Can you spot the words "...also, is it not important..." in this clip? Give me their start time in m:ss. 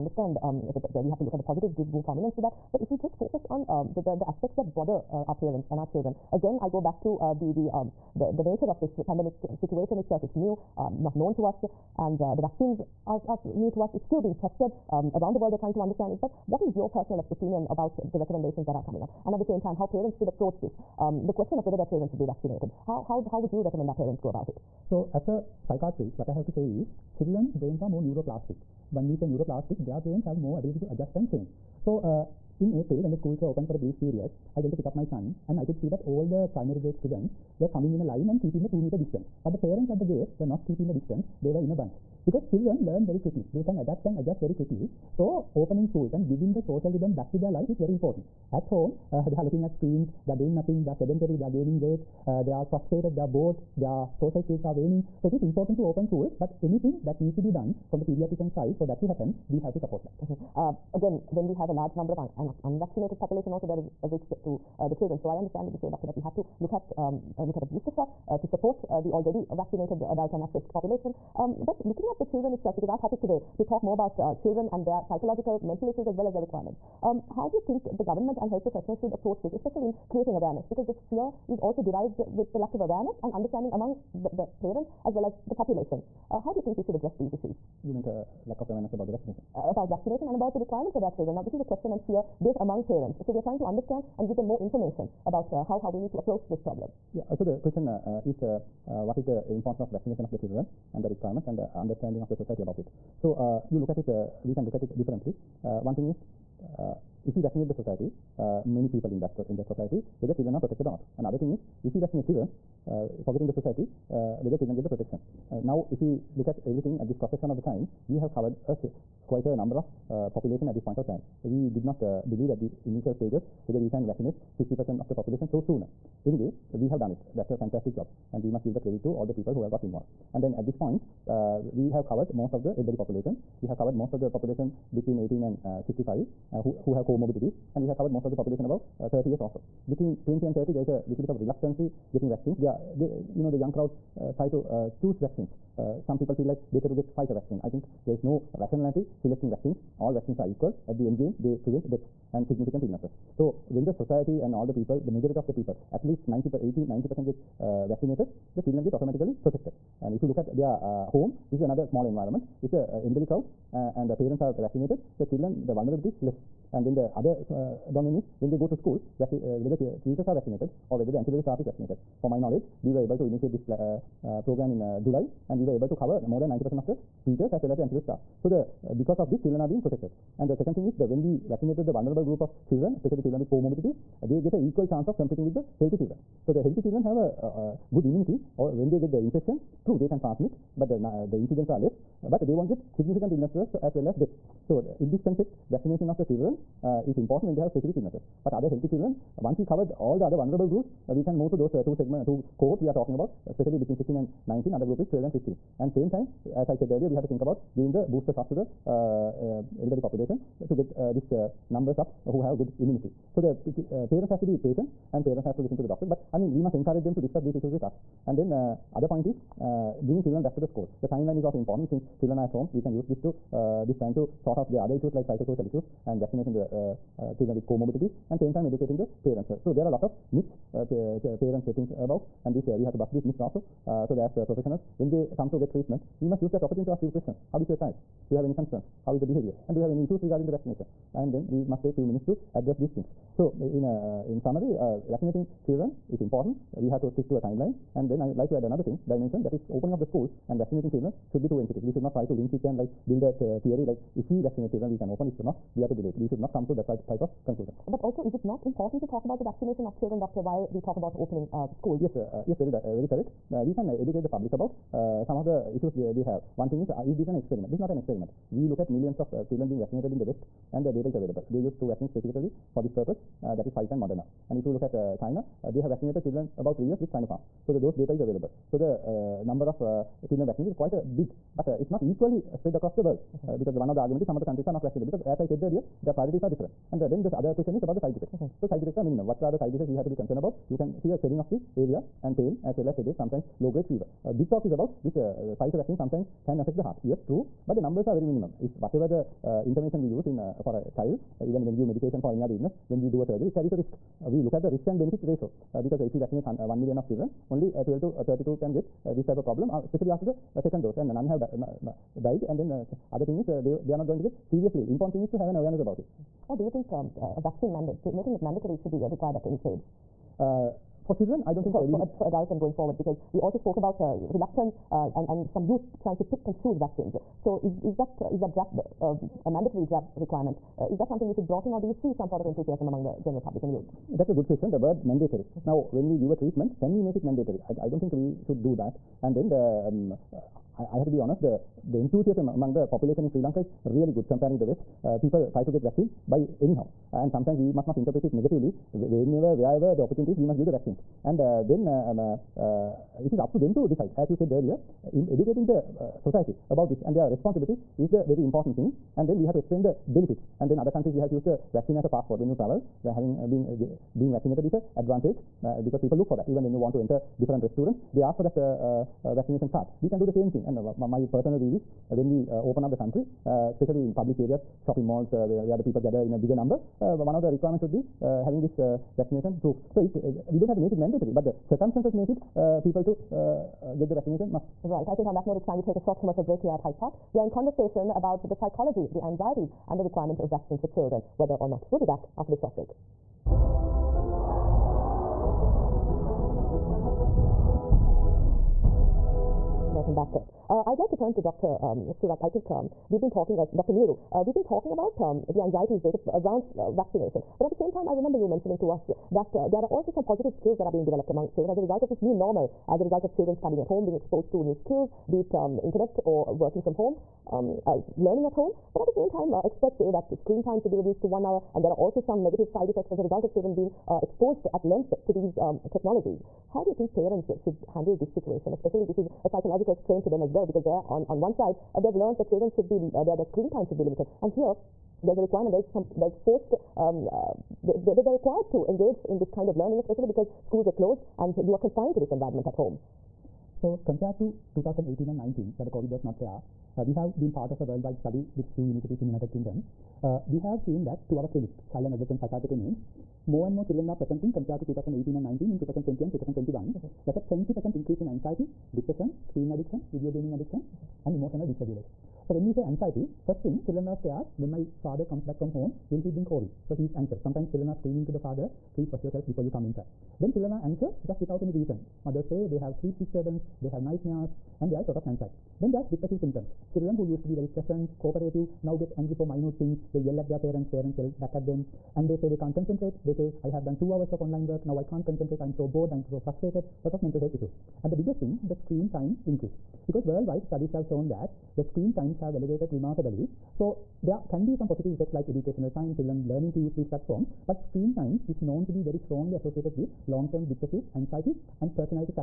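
4:18.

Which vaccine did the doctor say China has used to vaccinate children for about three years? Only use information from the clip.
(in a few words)
Sinopharm.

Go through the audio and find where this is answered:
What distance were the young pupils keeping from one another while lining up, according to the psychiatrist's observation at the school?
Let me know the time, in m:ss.
0:38.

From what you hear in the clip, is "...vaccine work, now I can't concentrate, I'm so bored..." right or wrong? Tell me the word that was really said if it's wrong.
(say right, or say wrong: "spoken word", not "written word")
wrong: "online", not "vaccine".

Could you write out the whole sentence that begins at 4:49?
What are the side effects we have to be concerned about?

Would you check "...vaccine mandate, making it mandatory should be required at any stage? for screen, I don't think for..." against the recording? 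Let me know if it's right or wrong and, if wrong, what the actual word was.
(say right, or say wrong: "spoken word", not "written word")
wrong: "children", not "screen".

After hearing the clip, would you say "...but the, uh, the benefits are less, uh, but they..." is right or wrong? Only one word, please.
wrong.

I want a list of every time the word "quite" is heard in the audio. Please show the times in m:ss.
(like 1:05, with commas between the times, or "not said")
1:59, 4:40.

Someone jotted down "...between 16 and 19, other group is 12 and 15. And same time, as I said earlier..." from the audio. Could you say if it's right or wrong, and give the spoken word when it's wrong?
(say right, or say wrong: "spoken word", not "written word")
right.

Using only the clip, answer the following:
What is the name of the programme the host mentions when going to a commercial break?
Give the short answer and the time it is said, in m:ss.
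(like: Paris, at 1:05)
Hyde Park, at 6:26.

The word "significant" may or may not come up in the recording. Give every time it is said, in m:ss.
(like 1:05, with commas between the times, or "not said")
2:32, 3:12.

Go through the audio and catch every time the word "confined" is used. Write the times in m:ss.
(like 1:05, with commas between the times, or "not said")
7:21.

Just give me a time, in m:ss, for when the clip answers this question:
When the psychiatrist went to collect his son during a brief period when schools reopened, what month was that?
0:32.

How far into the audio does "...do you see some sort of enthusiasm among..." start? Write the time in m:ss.
5:31.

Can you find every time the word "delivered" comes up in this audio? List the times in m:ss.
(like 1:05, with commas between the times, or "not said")
not said.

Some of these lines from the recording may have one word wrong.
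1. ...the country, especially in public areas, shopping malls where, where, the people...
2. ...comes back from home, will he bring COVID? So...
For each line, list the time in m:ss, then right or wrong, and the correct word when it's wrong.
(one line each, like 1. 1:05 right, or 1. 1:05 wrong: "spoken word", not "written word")
1. 6:12 right
2. 7:45 right.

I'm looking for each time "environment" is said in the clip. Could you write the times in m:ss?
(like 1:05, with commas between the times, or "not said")
2:42, 7:22.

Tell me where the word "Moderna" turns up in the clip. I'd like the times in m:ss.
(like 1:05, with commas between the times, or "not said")
4:34.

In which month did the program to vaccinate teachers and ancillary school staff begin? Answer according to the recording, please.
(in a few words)
July.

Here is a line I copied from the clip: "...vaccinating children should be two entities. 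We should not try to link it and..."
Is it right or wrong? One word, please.
right.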